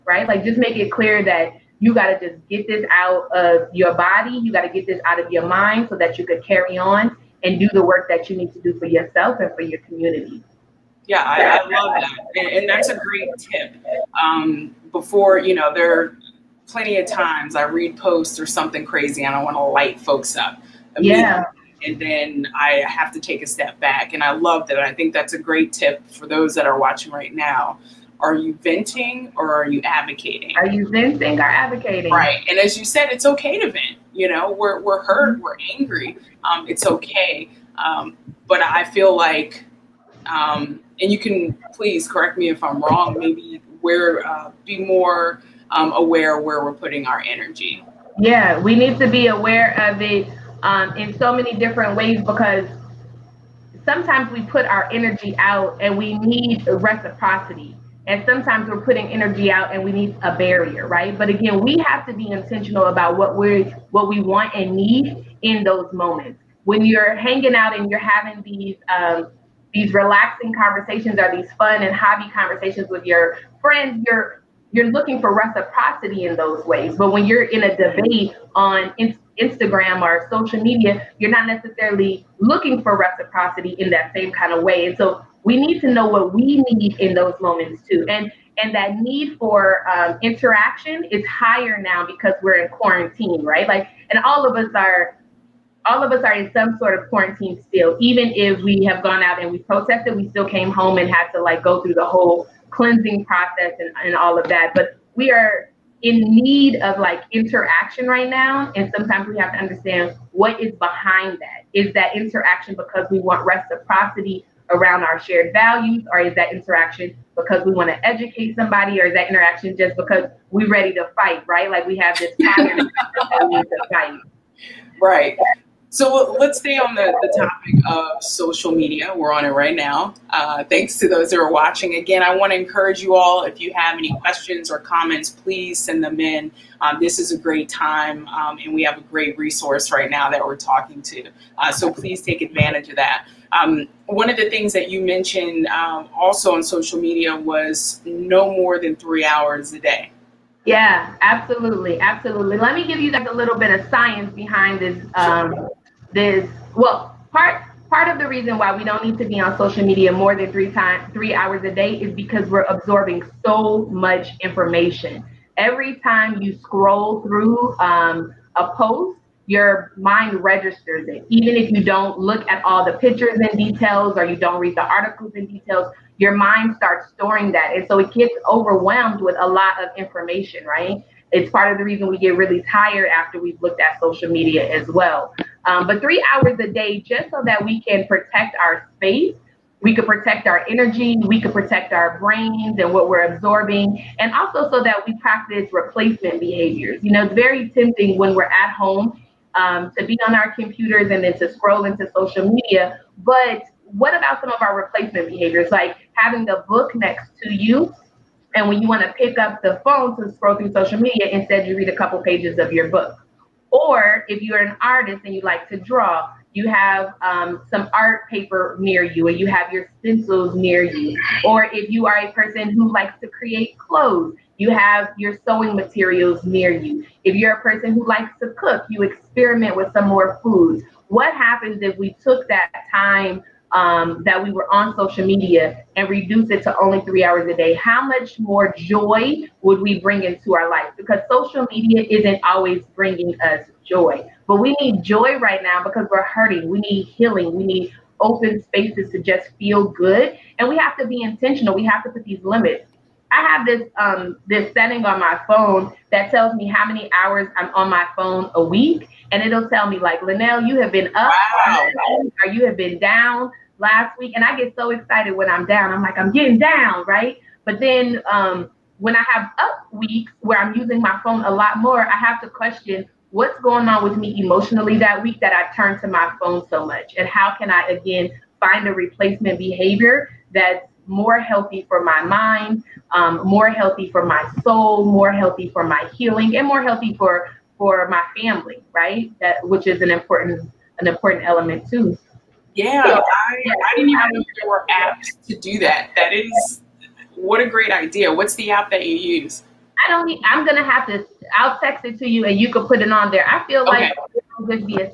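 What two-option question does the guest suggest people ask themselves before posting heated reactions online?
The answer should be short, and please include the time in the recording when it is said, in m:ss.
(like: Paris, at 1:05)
Venting or advocating, at 0:30.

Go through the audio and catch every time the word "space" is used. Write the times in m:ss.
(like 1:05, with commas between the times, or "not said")
3:08, 4:08.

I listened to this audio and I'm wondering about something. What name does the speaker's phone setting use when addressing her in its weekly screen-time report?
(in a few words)
Linnell.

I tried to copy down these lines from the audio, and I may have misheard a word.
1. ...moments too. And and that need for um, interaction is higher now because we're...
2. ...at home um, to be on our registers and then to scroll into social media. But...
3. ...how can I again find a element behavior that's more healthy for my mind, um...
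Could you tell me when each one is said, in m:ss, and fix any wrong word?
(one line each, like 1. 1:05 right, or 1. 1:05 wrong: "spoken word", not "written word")
1. 1:27 right
2. 3:18 wrong: "computers", not "registers"
3. 4:37 wrong: "replacement", not "element".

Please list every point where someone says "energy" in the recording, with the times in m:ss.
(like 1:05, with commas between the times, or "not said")
0:47, 0:54, 0:59, 3:10.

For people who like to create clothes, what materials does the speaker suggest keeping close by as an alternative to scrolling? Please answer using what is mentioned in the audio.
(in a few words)
Sewing materials.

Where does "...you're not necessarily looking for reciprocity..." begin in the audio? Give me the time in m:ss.
1:21.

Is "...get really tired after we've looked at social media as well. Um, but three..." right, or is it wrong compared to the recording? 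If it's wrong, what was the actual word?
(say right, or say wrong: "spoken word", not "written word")
right.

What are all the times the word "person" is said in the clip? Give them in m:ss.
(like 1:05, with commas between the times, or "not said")
3:42, 3:47.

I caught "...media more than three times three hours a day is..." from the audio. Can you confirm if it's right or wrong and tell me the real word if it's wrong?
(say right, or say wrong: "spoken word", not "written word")
right.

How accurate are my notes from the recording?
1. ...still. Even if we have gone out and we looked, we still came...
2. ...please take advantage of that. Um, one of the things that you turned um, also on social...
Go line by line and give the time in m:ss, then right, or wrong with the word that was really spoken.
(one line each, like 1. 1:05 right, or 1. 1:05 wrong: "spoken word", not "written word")
1. 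1:37 wrong: "protested", not "looked"
2. 2:21 wrong: "mentioned", not "turned".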